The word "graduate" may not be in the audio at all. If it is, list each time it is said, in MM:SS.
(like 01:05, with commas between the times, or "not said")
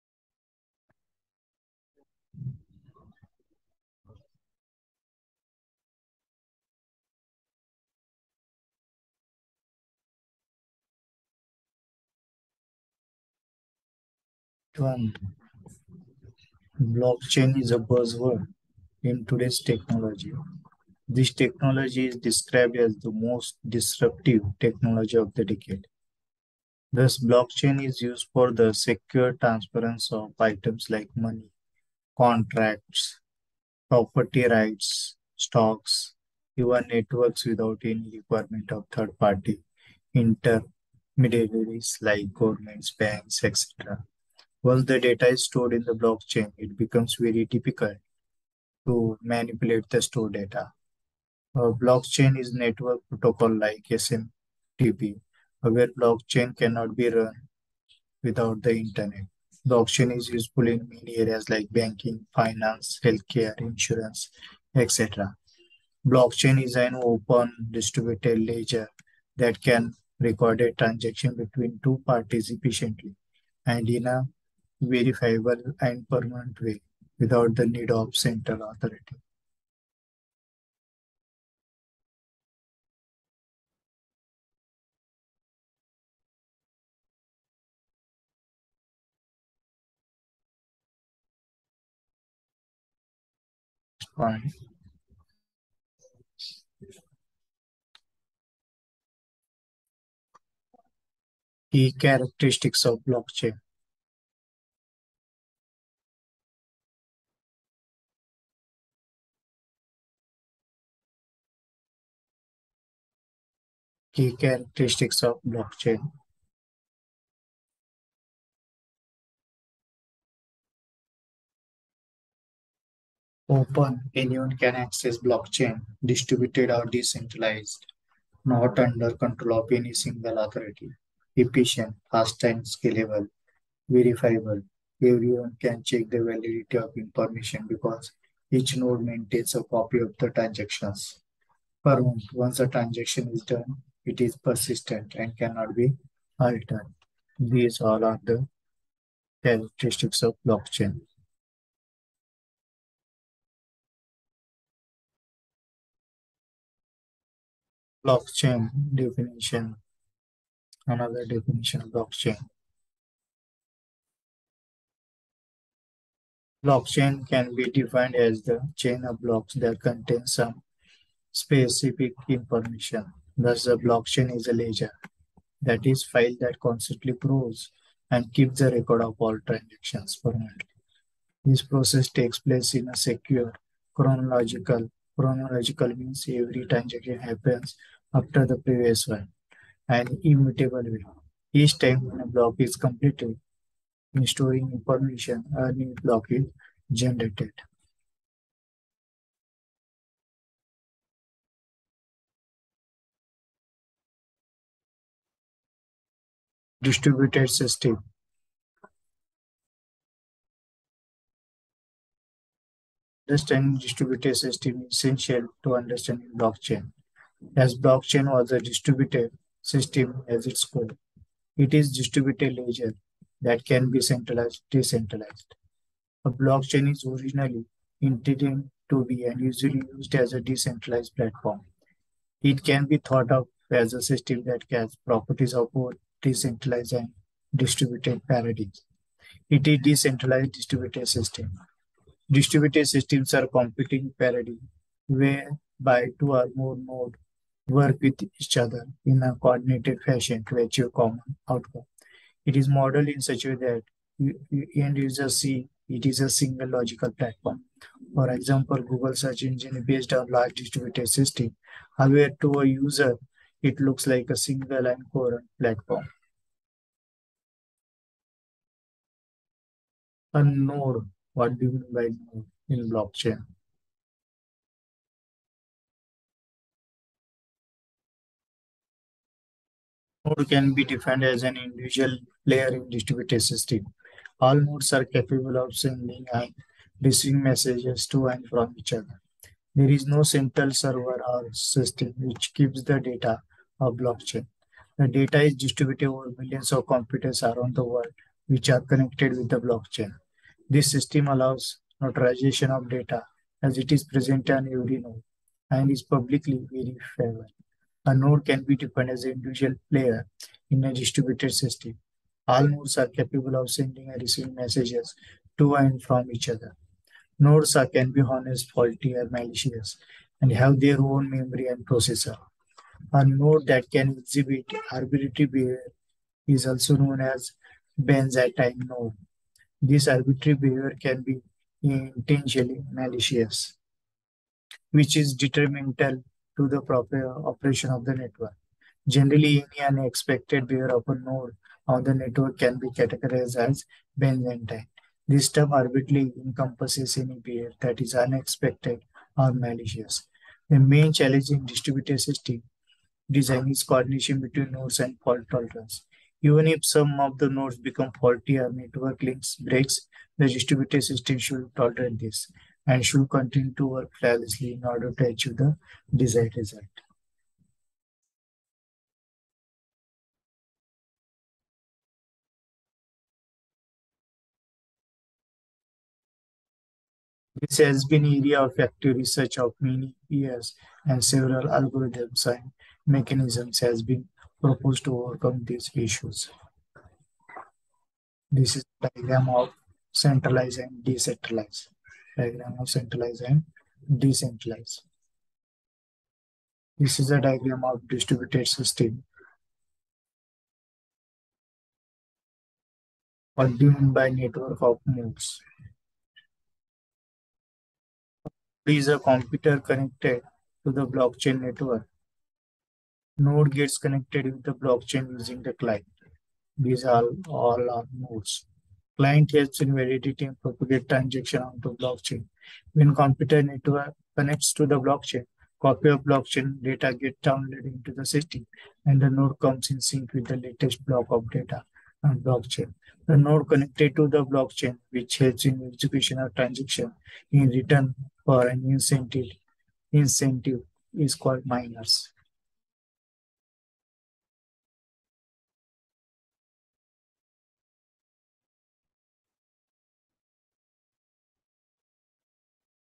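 not said.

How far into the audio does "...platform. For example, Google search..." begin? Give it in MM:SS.
04:17.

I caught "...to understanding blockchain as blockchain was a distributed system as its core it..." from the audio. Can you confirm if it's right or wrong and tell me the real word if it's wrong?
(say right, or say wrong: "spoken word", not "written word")
right.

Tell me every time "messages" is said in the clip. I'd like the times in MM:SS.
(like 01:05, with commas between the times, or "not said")
04:47, 05:14.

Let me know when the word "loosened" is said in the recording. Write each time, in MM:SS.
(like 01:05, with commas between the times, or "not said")
not said.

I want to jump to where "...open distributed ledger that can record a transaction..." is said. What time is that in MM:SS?
01:07.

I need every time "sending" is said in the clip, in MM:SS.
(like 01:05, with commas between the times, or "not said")
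04:45, 05:13.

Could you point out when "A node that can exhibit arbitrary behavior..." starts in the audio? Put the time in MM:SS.
05:23.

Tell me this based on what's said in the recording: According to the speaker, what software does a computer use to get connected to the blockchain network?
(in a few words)
The client.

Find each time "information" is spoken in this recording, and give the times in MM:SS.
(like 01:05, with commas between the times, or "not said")
02:16, 02:52, 03:14.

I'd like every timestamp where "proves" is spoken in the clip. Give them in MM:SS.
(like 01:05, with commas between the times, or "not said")
02:57.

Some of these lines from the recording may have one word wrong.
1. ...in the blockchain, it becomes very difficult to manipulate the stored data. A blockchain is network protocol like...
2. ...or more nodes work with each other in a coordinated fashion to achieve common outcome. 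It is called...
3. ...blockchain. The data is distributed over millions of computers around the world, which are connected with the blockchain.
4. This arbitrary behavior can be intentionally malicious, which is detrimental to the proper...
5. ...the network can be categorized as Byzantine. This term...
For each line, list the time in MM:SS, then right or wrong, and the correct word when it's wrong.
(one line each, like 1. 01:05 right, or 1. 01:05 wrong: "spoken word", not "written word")
1. 00:45 right
2. 04:06 wrong: "modeled", not "called"
3. 04:53 right
4. 05:29 right
5. 05:42 right.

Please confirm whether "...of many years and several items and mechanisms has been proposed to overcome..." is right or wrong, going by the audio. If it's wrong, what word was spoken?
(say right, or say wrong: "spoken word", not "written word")
wrong: "algorithms", not "items".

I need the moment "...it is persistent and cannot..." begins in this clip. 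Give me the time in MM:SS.
02:24.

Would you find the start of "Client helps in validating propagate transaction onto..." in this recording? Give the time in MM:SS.
06:59.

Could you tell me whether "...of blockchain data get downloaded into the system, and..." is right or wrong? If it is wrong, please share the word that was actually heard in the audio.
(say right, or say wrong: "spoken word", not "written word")
right.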